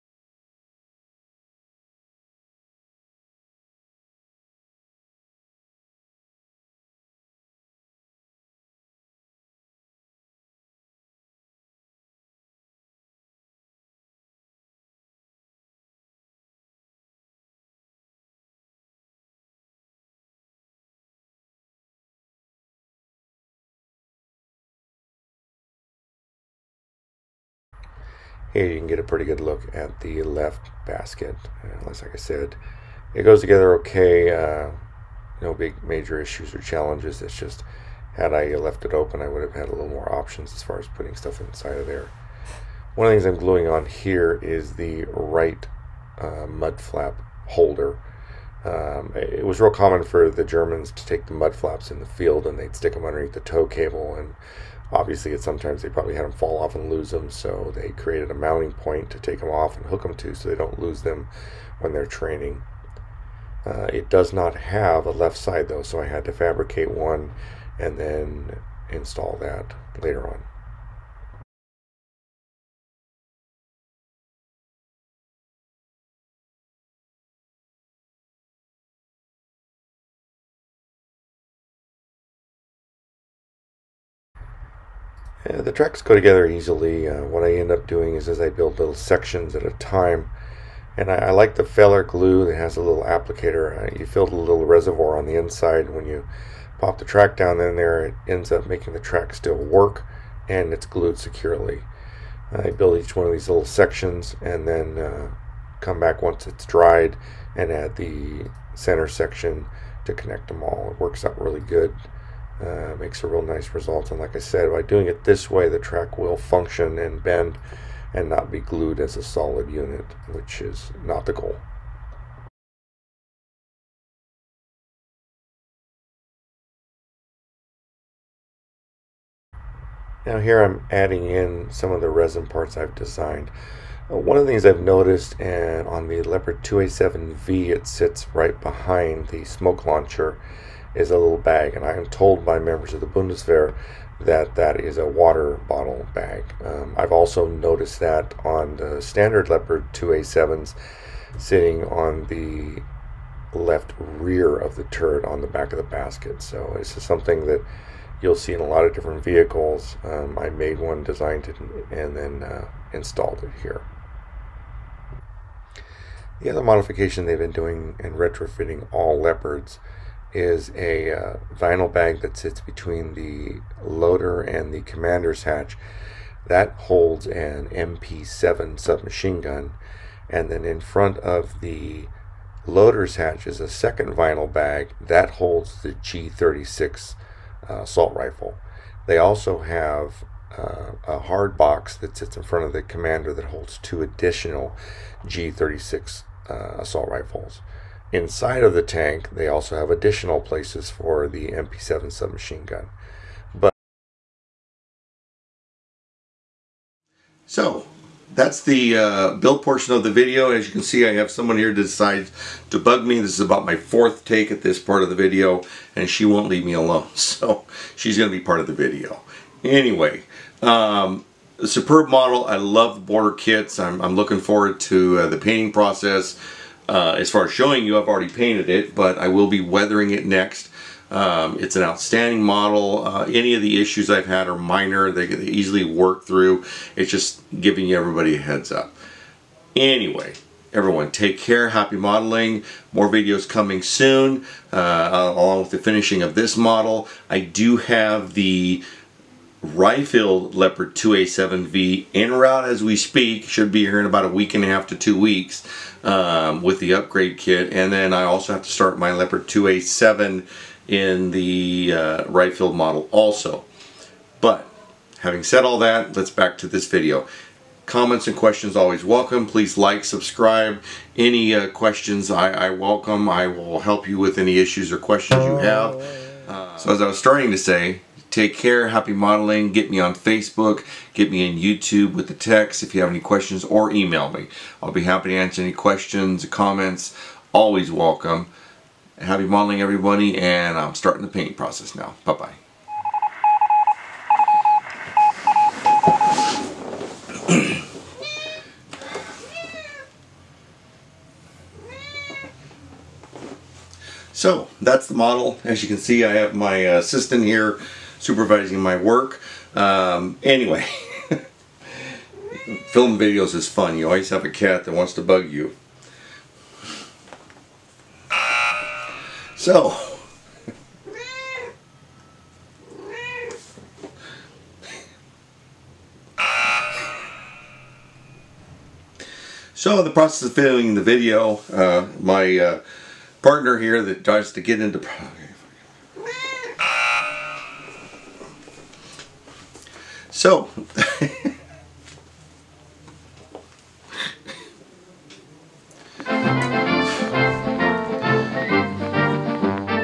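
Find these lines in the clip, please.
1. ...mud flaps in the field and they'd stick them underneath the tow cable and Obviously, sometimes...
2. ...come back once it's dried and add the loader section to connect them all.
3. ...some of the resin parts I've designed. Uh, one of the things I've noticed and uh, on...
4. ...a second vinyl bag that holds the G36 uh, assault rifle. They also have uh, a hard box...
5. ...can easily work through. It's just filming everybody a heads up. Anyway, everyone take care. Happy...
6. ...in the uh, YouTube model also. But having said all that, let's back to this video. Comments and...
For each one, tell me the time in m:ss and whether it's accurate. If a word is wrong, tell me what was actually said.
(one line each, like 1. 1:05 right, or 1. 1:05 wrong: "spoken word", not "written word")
1. 0:51 right
2. 1:45 wrong: "center", not "loader"
3. 2:11 right
4. 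3:03 right
5. 3:55 wrong: "giving", not "filming"
6. 4:20 wrong: "Ryefield", not "YouTube".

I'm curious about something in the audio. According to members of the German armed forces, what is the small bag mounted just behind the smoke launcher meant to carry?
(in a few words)
water bottle.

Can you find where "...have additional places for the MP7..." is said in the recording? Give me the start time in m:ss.
3:19.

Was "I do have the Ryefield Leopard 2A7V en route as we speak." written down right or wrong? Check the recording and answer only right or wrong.
right.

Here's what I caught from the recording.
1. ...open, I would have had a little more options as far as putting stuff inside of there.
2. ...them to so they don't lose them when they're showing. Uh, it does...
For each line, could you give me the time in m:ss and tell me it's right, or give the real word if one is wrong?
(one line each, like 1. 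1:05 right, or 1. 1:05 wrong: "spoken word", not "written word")
1. 0:38 right
2. 1:00 wrong: "training", not "showing".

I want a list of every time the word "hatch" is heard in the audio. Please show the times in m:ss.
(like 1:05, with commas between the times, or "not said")
2:55, 3:03.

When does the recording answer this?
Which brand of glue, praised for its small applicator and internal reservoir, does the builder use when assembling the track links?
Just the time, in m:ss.
1:31.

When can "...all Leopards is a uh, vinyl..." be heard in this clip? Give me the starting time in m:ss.
2:48.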